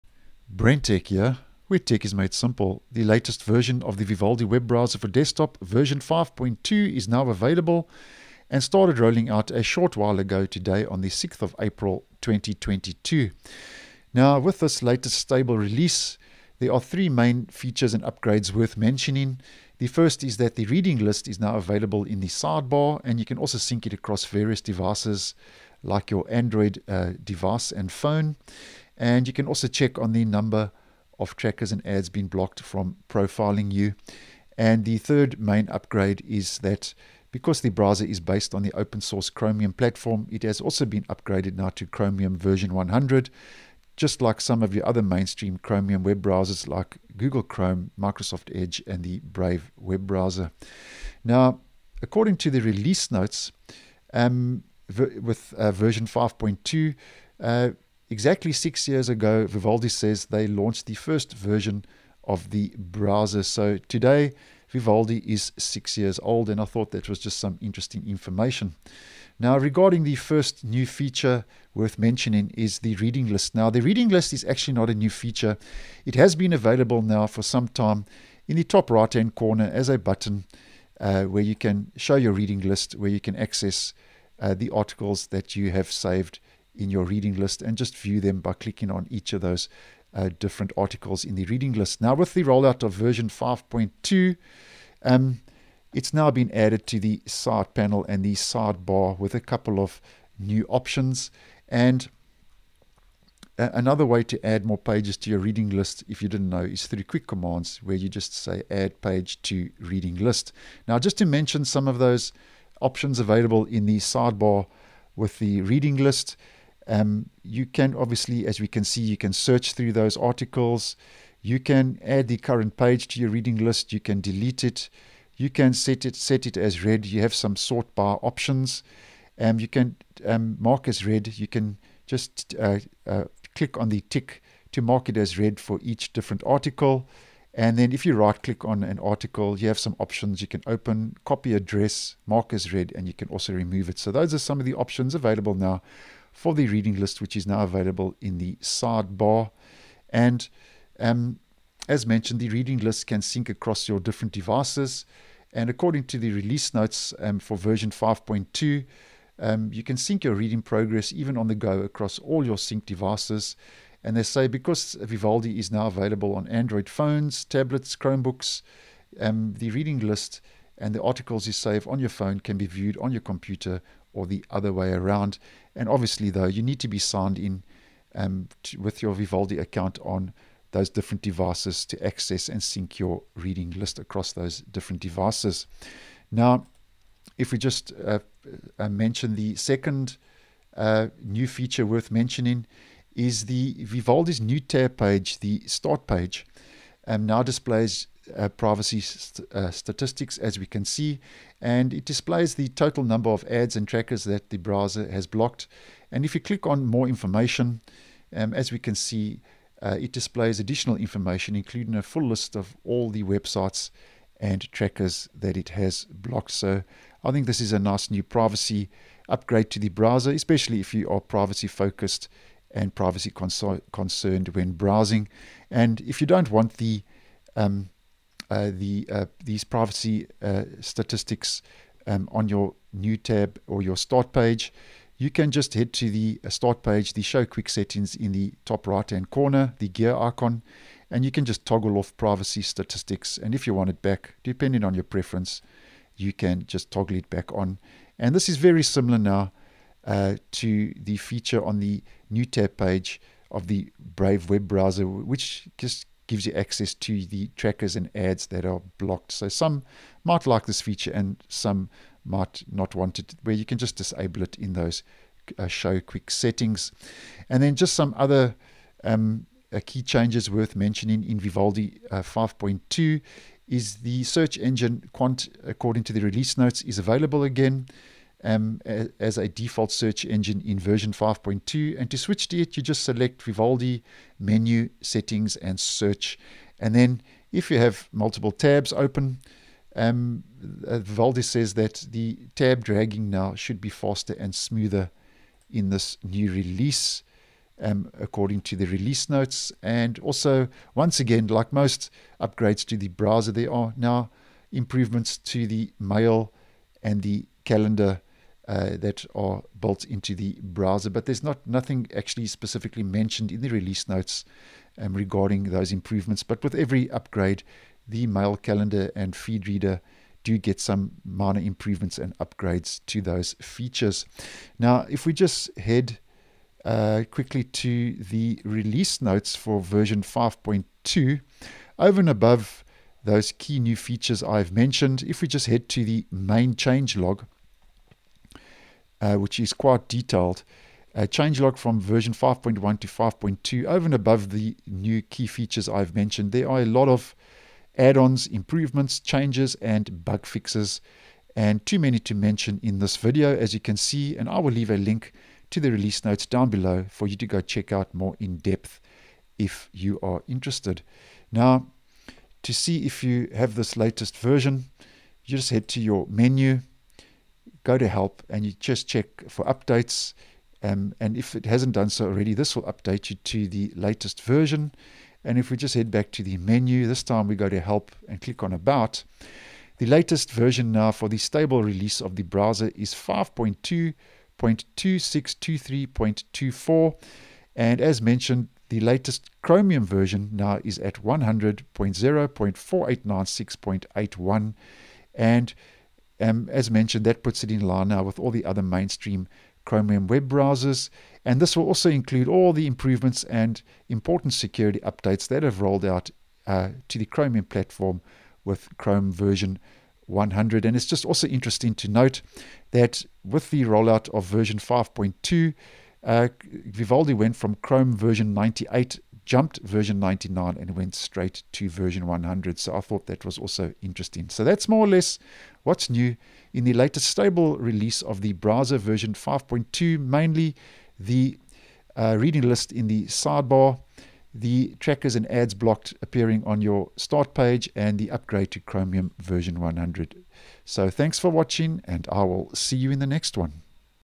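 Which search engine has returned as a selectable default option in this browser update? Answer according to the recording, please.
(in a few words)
Qwant.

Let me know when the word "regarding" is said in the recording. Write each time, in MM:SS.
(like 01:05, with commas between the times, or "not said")
01:09, 05:15.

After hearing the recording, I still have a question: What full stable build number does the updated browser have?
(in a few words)
5.2.2623.24.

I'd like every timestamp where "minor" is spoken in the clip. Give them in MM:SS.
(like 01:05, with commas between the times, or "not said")
05:21.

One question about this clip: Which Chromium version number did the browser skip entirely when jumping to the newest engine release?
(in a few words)
99.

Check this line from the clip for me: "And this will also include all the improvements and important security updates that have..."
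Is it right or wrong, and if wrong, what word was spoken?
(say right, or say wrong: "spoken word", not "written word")
right.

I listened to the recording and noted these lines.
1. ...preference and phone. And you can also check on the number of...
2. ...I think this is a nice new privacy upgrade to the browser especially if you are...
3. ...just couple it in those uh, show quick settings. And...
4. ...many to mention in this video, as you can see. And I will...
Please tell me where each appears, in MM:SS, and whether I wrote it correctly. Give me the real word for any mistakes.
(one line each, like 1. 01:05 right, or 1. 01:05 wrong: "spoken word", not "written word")
1. 00:27 wrong: "device", not "preference"
2. 03:37 right
3. 04:23 wrong: "disable", not "couple"
4. 05:51 right.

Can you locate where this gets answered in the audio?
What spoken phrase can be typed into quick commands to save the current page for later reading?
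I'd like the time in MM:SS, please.
01:48.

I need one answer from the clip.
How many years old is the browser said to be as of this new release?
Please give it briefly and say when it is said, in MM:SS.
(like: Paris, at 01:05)
6, at 01:05.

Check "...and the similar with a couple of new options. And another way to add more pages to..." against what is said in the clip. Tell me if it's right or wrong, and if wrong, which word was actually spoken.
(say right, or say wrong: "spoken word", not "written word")
wrong: "sidebar", not "similar".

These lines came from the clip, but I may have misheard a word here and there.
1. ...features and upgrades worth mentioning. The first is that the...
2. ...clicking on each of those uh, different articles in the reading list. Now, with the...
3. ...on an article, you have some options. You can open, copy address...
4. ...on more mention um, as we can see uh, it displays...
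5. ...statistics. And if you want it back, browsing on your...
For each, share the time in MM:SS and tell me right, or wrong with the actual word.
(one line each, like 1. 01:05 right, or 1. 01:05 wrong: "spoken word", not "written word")
1. 00:17 right
2. 01:28 right
3. 02:18 right
4. 03:26 wrong: "information", not "mention"
5. 04:02 wrong: "depending", not "browsing".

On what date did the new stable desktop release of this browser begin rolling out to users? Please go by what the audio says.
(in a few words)
6th of April 2022.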